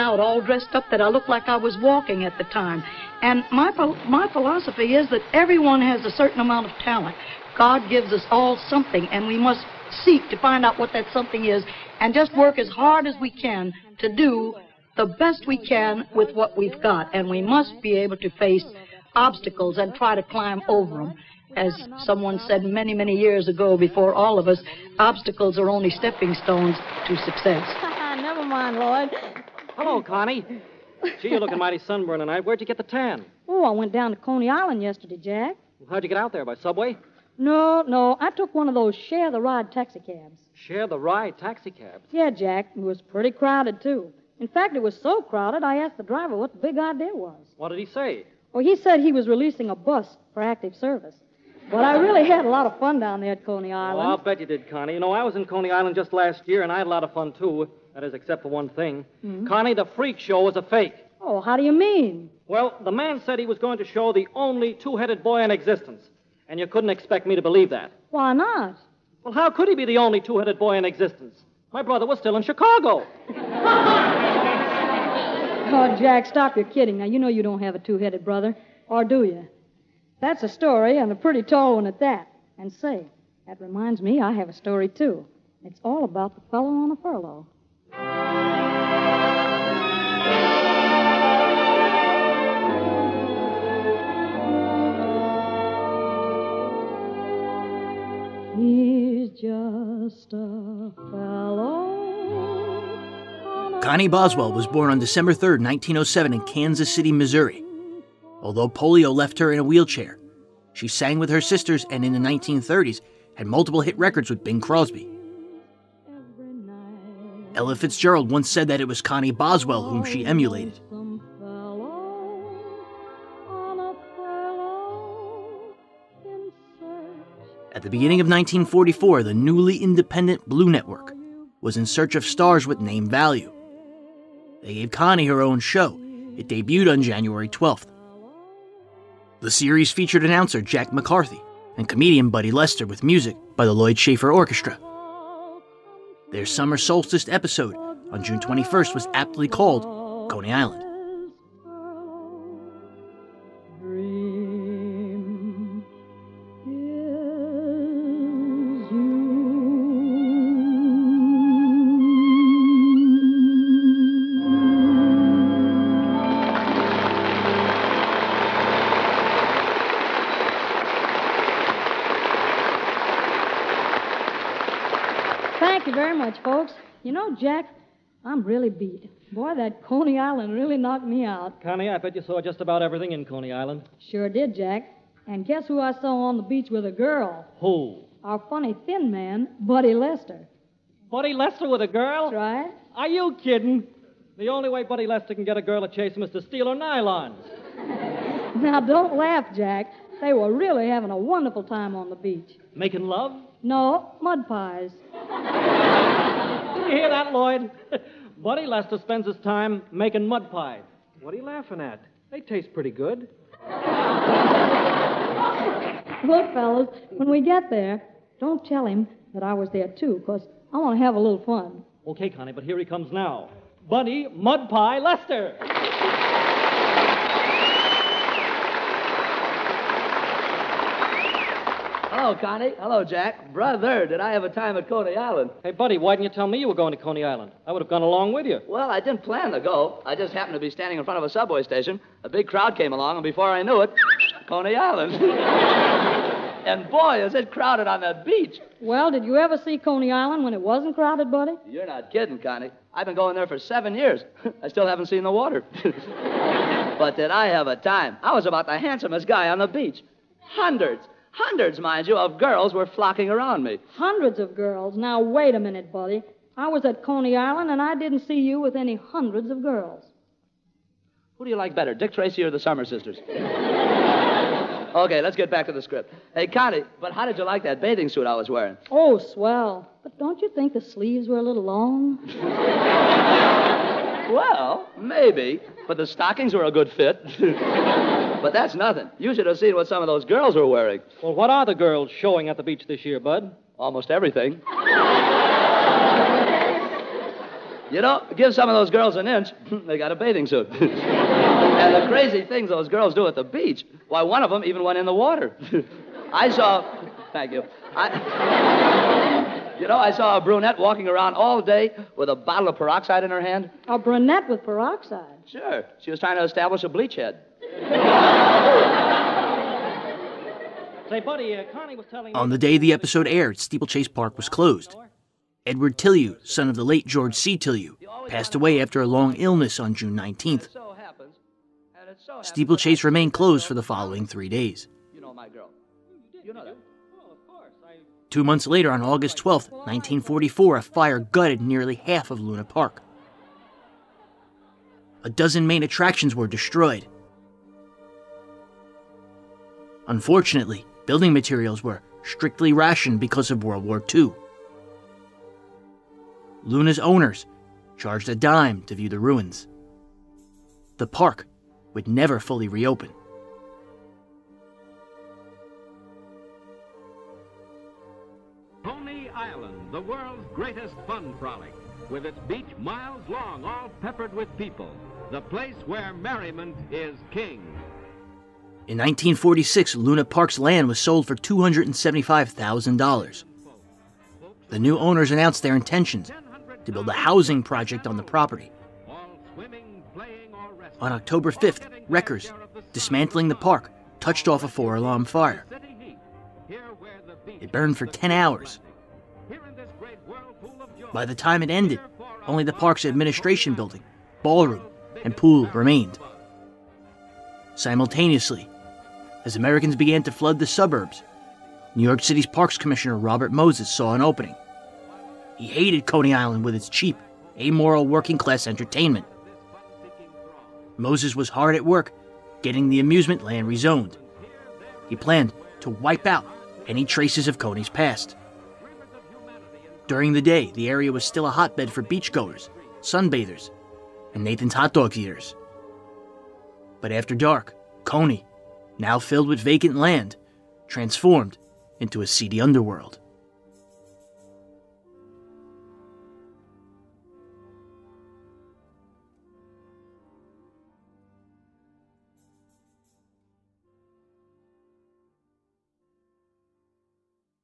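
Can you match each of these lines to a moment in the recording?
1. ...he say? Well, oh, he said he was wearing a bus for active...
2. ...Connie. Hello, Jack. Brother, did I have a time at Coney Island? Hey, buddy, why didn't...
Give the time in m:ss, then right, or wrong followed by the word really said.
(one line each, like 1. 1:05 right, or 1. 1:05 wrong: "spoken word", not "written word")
1. 0:47 wrong: "releasing", not "wearing"
2. 3:52 right.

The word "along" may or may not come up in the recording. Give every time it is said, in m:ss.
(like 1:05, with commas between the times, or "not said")
3:58, 4:02.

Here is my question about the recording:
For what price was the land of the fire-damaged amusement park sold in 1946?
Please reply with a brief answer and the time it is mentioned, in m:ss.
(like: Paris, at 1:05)
$275,000, at 6:21.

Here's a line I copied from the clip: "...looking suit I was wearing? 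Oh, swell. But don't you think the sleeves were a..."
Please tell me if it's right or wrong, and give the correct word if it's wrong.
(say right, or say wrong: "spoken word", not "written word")
wrong: "bathing", not "looking".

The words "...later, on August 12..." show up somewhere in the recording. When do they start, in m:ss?
5:38.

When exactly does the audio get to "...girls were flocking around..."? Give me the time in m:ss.
4:22.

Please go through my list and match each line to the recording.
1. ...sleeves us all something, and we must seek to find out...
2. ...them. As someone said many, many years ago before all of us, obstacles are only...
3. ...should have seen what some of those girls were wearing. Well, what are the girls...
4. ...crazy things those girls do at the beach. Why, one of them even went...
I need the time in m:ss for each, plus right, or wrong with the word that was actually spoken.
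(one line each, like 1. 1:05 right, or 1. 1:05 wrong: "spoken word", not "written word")
1. 0:07 wrong: "gives", not "sleeves"
2. 0:21 right
3. 4:49 right
4. 5:02 right.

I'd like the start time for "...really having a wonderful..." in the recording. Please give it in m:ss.
3:20.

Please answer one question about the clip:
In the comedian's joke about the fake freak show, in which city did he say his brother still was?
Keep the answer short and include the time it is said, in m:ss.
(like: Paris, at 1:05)
Chicago, at 1:12.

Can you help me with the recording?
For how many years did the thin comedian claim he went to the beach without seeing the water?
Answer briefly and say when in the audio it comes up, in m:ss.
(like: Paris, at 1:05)
7, at 4:13.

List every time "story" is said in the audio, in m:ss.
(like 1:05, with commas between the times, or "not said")
1:20, 1:24.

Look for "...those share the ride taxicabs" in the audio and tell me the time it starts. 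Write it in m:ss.
0:38.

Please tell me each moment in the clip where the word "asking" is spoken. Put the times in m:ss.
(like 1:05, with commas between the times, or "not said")
not said.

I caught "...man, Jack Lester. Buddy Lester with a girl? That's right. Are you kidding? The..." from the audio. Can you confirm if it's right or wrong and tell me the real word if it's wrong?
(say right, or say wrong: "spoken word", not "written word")
wrong: "Buddy", not "Jack".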